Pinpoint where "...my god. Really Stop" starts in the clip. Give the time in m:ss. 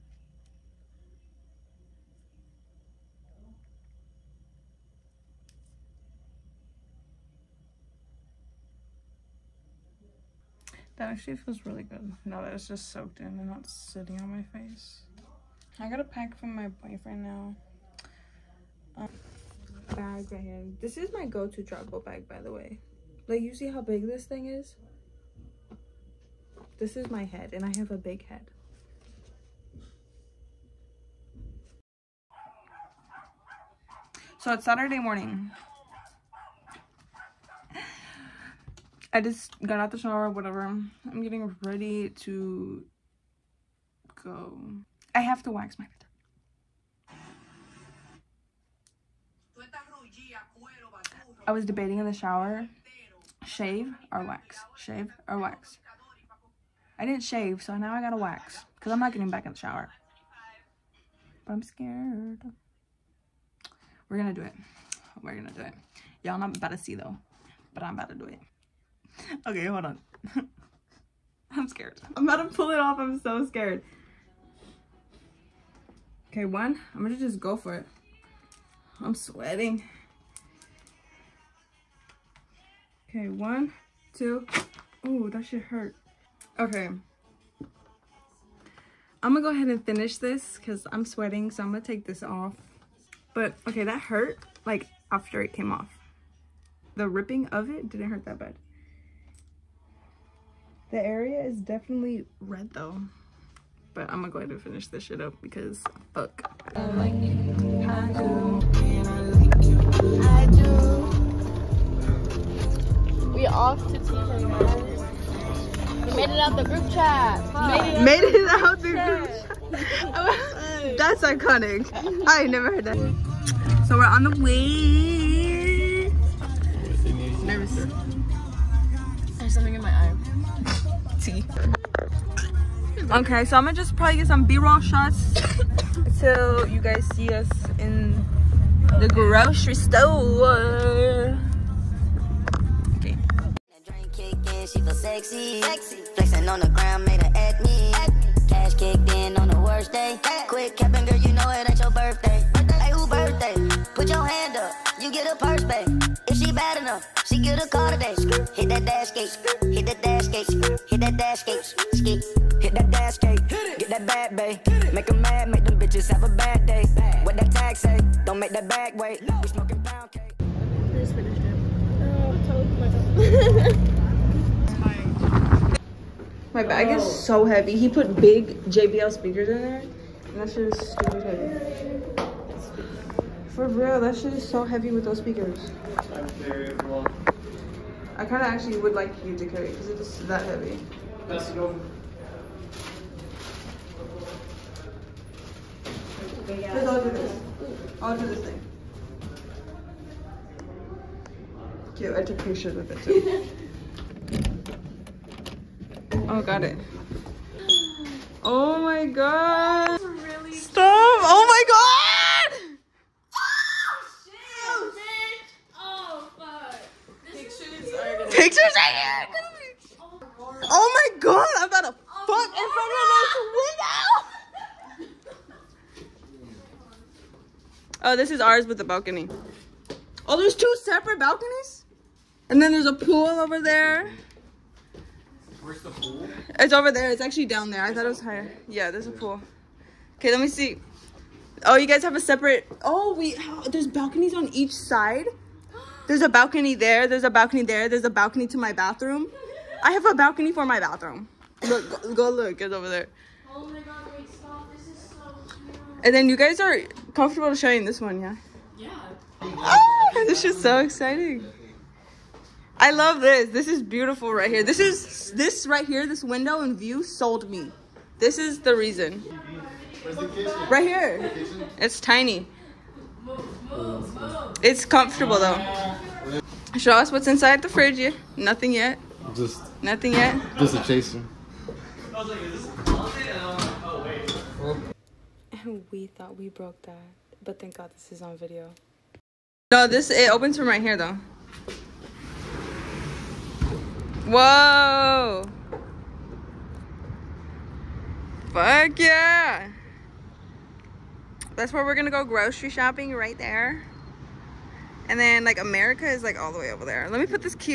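3:28.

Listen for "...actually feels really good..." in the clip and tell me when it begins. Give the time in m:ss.
0:11.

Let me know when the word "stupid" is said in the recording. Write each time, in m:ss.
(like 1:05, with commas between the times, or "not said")
3:00.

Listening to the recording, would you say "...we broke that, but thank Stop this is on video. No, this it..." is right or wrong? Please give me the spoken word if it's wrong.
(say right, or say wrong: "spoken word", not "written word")
wrong: "God", not "Stop".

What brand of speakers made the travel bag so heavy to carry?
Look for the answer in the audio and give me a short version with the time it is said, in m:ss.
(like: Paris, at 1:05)
JBL, at 2:58.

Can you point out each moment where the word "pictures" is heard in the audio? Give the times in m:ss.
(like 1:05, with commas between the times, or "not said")
3:22, 3:38.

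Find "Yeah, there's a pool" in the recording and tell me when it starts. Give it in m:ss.
3:58.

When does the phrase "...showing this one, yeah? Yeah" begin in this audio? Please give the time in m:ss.
4:17.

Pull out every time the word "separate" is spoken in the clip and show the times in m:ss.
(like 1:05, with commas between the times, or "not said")
3:50, 4:02.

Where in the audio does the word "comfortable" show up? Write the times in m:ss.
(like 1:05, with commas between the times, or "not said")
4:17, 4:34.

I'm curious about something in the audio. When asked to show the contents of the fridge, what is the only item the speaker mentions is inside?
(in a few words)
A chaser.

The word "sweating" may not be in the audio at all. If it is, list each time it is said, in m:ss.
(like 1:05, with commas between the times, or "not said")
1:19, 1:31.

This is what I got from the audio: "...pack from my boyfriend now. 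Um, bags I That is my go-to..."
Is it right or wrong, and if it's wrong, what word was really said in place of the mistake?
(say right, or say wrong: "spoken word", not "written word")
wrong: "This", not "That".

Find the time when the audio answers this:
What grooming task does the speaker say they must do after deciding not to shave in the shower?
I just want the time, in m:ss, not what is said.
0:45.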